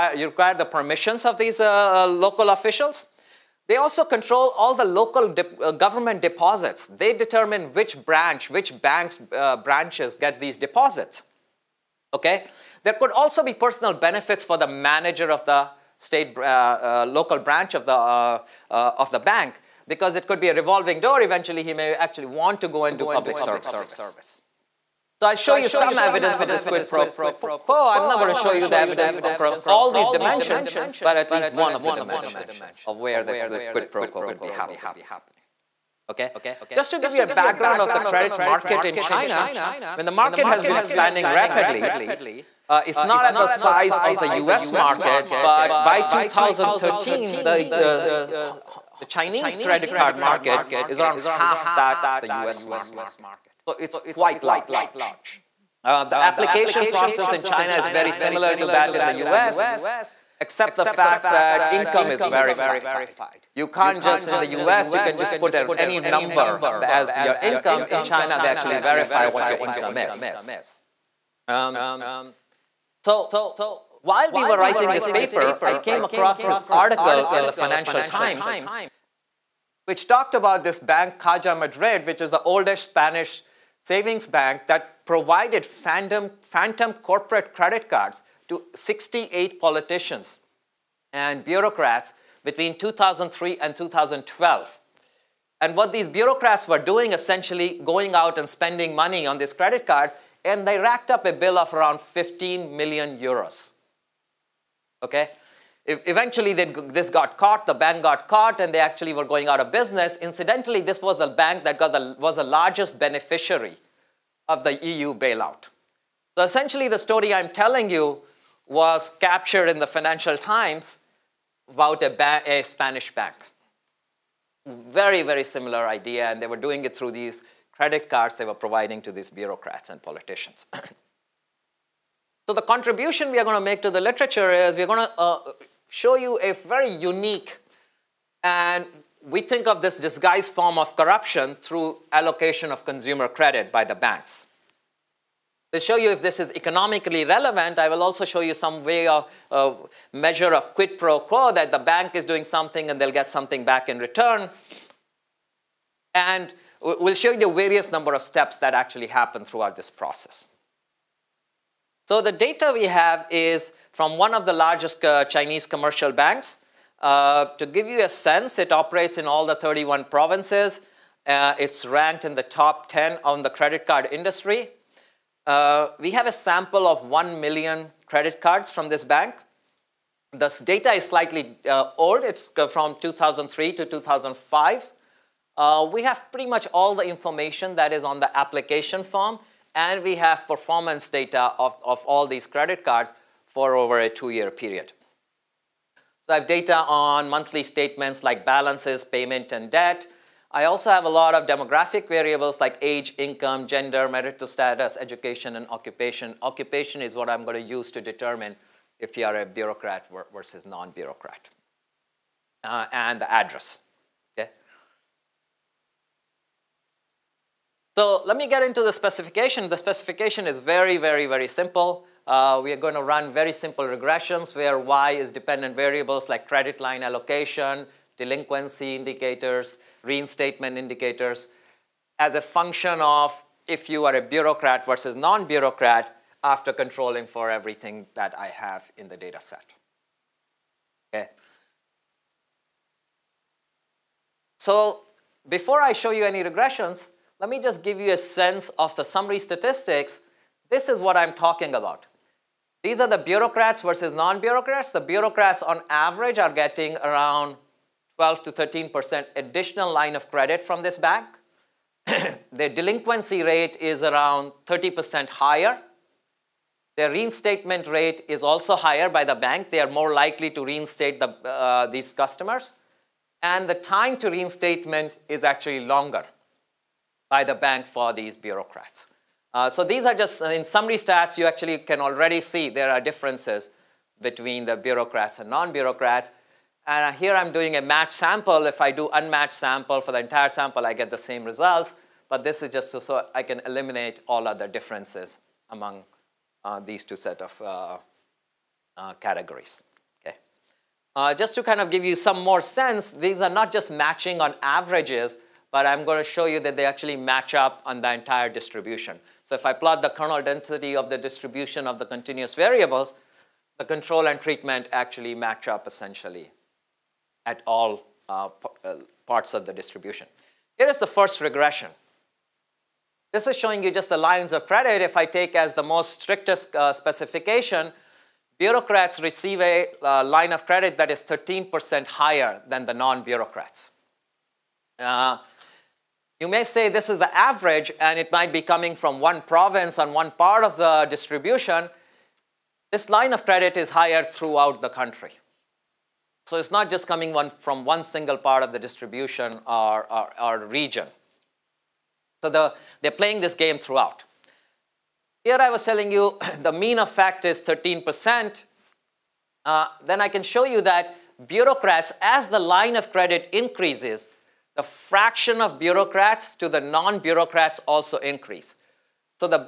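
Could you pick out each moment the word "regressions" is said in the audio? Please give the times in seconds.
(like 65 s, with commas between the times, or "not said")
223 s, 246 s, 321 s.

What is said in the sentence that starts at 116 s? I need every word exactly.
So essentially, the story I'm telling you was captured in the Financial Times about a, a Spanish bank.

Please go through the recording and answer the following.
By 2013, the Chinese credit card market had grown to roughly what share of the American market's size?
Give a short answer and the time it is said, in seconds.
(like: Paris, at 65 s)
half, at 51 s.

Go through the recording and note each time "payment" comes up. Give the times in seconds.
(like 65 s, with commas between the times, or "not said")
199 s.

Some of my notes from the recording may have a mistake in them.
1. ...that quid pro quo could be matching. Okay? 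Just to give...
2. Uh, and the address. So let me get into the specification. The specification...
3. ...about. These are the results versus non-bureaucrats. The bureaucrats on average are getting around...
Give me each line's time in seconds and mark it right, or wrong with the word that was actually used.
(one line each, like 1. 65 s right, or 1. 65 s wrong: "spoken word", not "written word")
1. 33 s wrong: "happening", not "matching"
2. 212 s right
3. 251 s wrong: "bureaucrats", not "results".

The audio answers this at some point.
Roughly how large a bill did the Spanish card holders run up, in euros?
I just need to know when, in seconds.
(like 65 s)
102 s.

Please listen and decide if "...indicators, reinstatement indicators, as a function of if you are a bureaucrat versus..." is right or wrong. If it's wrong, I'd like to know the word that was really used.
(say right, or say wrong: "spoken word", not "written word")
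right.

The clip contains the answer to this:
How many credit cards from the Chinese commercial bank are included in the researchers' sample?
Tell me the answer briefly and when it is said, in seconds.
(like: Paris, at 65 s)
1 million, at 177 s.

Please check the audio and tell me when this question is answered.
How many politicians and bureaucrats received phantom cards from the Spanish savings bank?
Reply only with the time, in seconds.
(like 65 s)
88 s.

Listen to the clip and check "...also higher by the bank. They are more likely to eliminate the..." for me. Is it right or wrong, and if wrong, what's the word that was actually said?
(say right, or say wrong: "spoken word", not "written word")
wrong: "reinstate", not "eliminate".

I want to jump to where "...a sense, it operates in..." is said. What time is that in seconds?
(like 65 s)
168 s.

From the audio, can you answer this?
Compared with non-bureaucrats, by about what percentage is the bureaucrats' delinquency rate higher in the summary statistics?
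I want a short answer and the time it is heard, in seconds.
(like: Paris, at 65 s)
30%, at 264 s.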